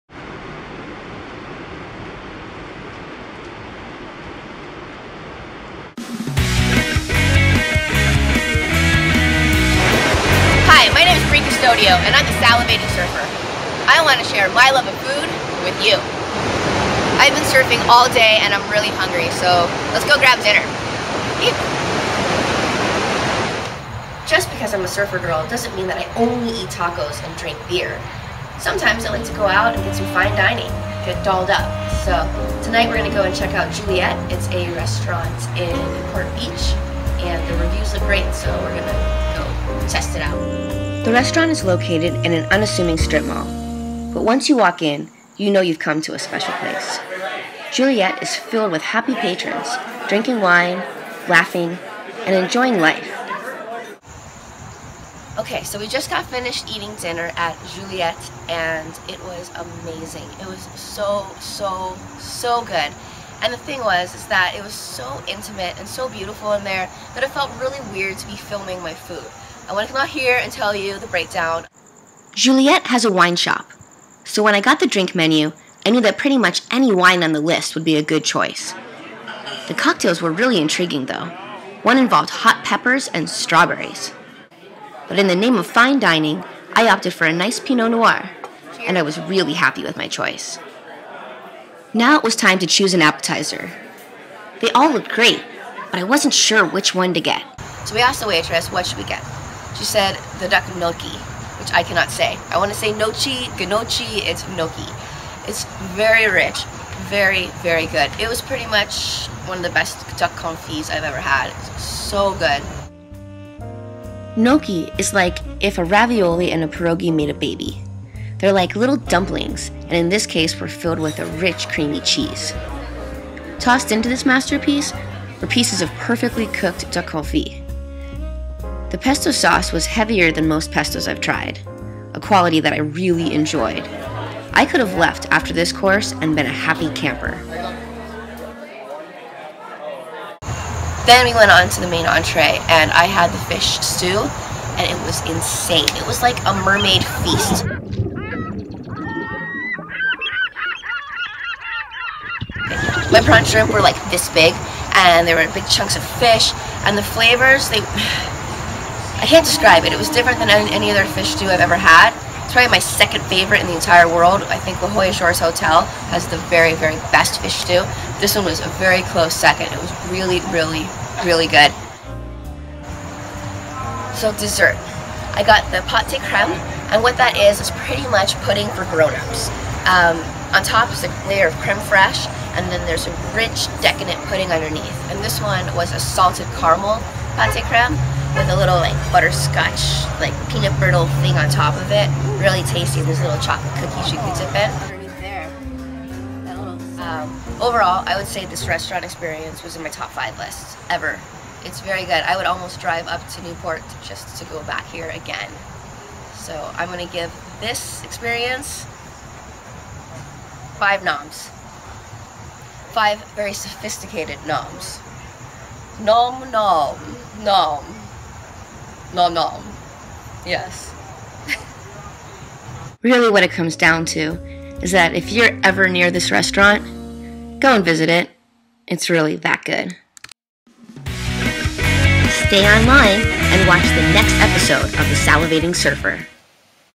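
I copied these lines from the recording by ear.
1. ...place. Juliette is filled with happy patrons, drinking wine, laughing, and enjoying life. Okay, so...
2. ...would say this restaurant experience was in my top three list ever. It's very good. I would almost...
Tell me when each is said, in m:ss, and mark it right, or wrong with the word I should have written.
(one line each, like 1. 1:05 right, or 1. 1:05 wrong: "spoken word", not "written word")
1. 0:46 right
2. 3:18 wrong: "five", not "three".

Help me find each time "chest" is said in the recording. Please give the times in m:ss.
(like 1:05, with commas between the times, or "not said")
not said.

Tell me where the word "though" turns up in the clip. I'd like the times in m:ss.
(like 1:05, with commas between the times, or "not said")
1:21.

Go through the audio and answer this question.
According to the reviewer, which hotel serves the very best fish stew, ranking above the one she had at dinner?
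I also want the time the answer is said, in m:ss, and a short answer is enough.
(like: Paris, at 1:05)
La Jolla Shores Hotel, at 2:44.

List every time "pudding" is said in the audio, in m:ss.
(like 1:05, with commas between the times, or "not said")
2:58, 3:04.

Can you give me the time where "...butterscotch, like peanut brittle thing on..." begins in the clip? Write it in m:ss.
3:09.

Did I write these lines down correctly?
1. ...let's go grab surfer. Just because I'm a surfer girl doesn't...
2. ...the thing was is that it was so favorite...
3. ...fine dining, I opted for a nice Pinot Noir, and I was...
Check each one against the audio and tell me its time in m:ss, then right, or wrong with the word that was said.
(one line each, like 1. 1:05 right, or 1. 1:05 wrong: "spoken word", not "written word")
1. 0:19 wrong: "dinner", not "surfer"
2. 1:03 wrong: "intimate", not "favorite"
3. 1:25 right.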